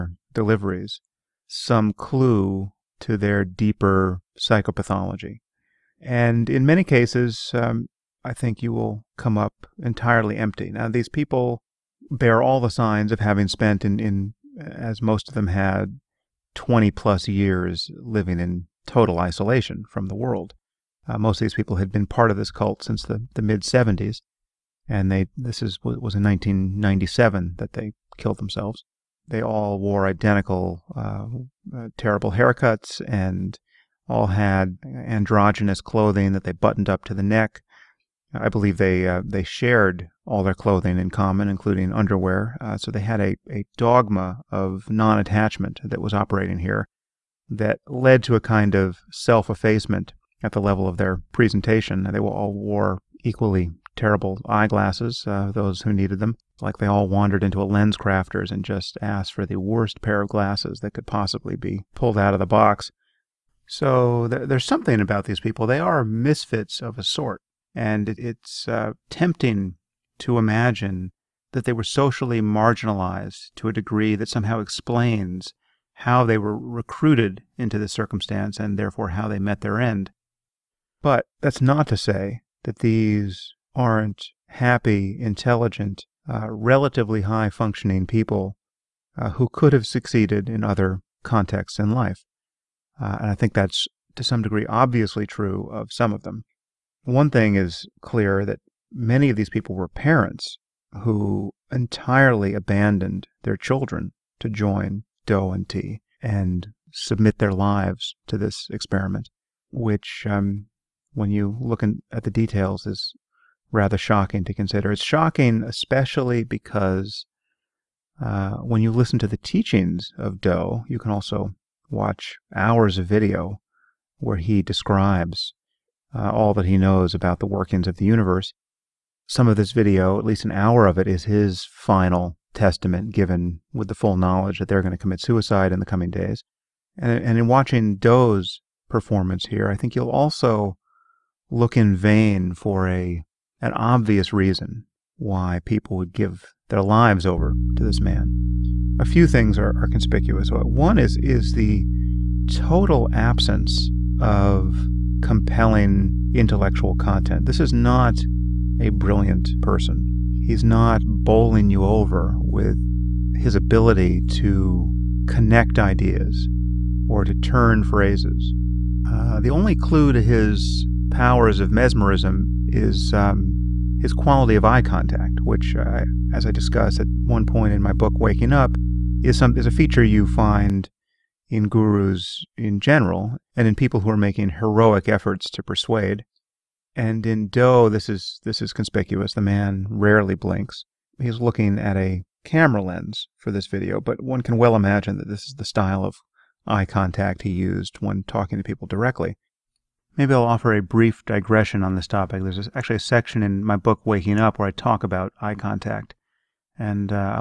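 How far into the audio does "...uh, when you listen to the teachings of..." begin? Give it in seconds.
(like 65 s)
118 s.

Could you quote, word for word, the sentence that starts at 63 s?
So there's something about these people.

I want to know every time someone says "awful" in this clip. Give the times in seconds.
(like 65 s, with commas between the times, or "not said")
not said.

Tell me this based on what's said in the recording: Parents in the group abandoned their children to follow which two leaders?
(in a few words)
Doe and T.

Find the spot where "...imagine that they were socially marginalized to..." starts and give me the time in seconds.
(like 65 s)
70 s.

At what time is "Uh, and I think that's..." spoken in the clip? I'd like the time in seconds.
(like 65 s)
92 s.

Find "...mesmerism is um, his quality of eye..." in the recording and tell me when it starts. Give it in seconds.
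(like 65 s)
171 s.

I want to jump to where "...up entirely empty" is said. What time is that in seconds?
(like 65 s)
9 s.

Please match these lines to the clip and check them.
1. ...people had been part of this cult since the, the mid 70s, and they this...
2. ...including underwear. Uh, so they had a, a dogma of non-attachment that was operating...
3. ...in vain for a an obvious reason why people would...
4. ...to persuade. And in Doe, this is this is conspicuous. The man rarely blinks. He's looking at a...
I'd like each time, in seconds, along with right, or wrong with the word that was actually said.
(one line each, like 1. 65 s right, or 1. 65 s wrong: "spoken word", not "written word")
1. 21 s right
2. 41 s right
3. 141 s right
4. 185 s right.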